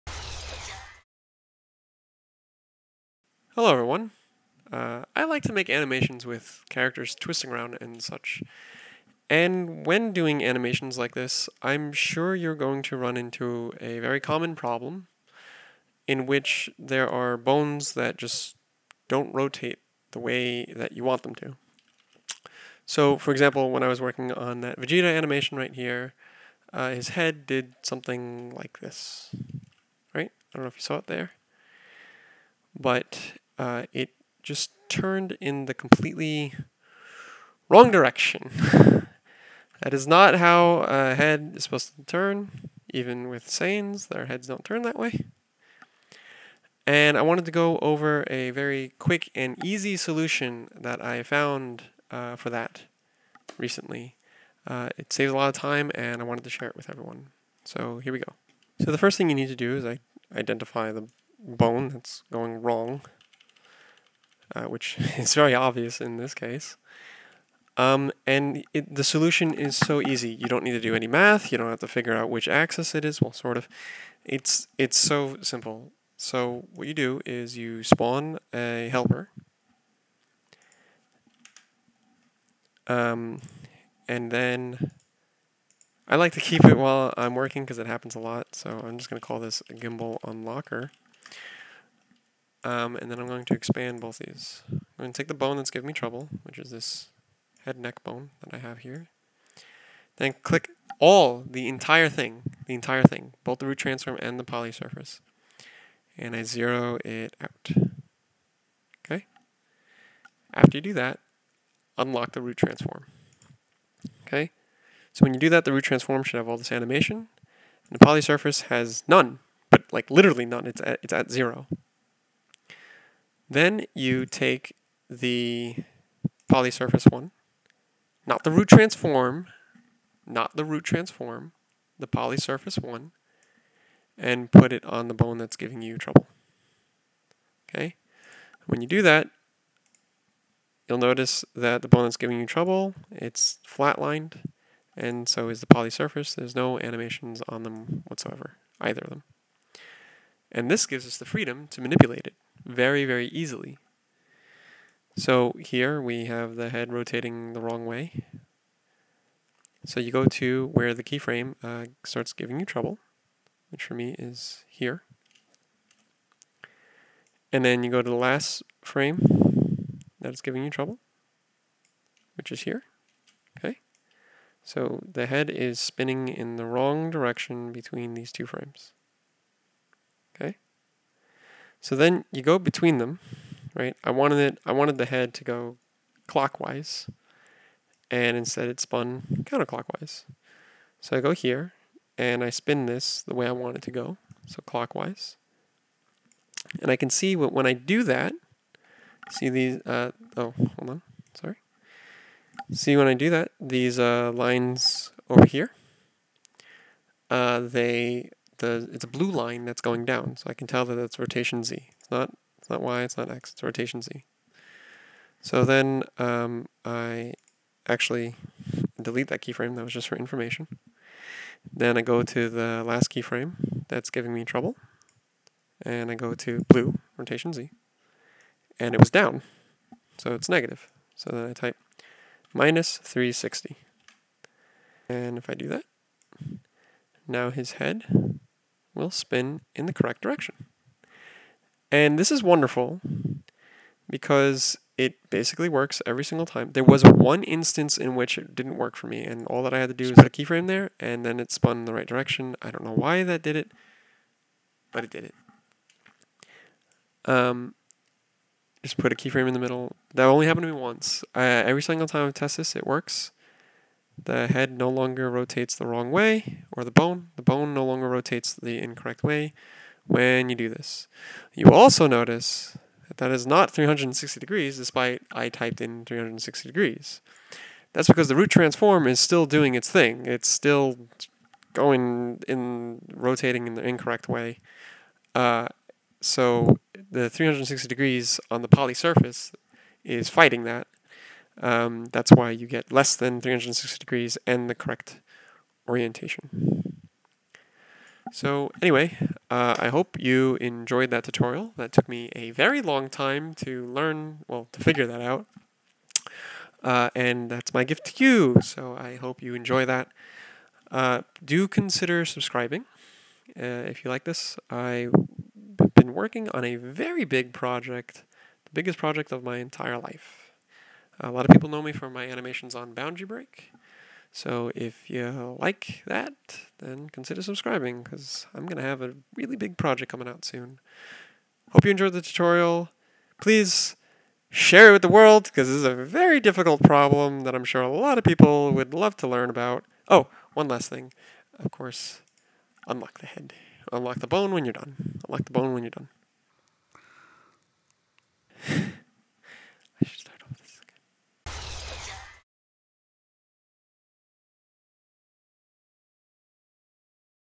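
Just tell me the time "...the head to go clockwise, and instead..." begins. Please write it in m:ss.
3:04.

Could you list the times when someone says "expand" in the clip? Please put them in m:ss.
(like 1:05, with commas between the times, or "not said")
1:33.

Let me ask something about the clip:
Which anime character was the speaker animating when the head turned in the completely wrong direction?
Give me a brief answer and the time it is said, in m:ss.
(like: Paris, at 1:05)
Vegeta, at 0:24.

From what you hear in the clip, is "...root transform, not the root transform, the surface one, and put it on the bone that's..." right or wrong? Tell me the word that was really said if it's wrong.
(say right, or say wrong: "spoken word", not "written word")
wrong: "polysurface", not "surface".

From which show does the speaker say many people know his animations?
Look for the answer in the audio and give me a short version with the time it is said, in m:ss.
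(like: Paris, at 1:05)
Boundary Break, at 5:22.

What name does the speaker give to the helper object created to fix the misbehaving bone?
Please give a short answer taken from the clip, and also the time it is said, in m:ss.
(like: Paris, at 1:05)
gimbal unlocker, at 1:29.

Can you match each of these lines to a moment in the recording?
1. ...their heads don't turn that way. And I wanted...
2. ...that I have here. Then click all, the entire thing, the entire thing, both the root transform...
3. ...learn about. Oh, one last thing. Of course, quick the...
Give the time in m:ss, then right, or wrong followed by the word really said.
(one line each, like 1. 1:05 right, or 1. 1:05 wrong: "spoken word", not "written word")
1. 0:44 right
2. 1:38 right
3. 5:39 wrong: "unlock", not "quick".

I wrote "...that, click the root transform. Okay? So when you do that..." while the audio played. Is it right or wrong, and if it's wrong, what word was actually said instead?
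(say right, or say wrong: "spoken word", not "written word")
wrong: "unlock", not "click".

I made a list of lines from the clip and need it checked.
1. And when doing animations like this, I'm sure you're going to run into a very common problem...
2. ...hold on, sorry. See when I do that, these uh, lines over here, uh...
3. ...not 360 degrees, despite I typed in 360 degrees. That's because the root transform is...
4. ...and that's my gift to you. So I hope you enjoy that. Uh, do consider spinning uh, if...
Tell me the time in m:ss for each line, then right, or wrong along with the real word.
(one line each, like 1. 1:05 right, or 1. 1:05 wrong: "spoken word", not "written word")
1. 0:09 right
2. 3:20 right
3. 4:33 right
4. 5:07 wrong: "subscribing", not "spinning".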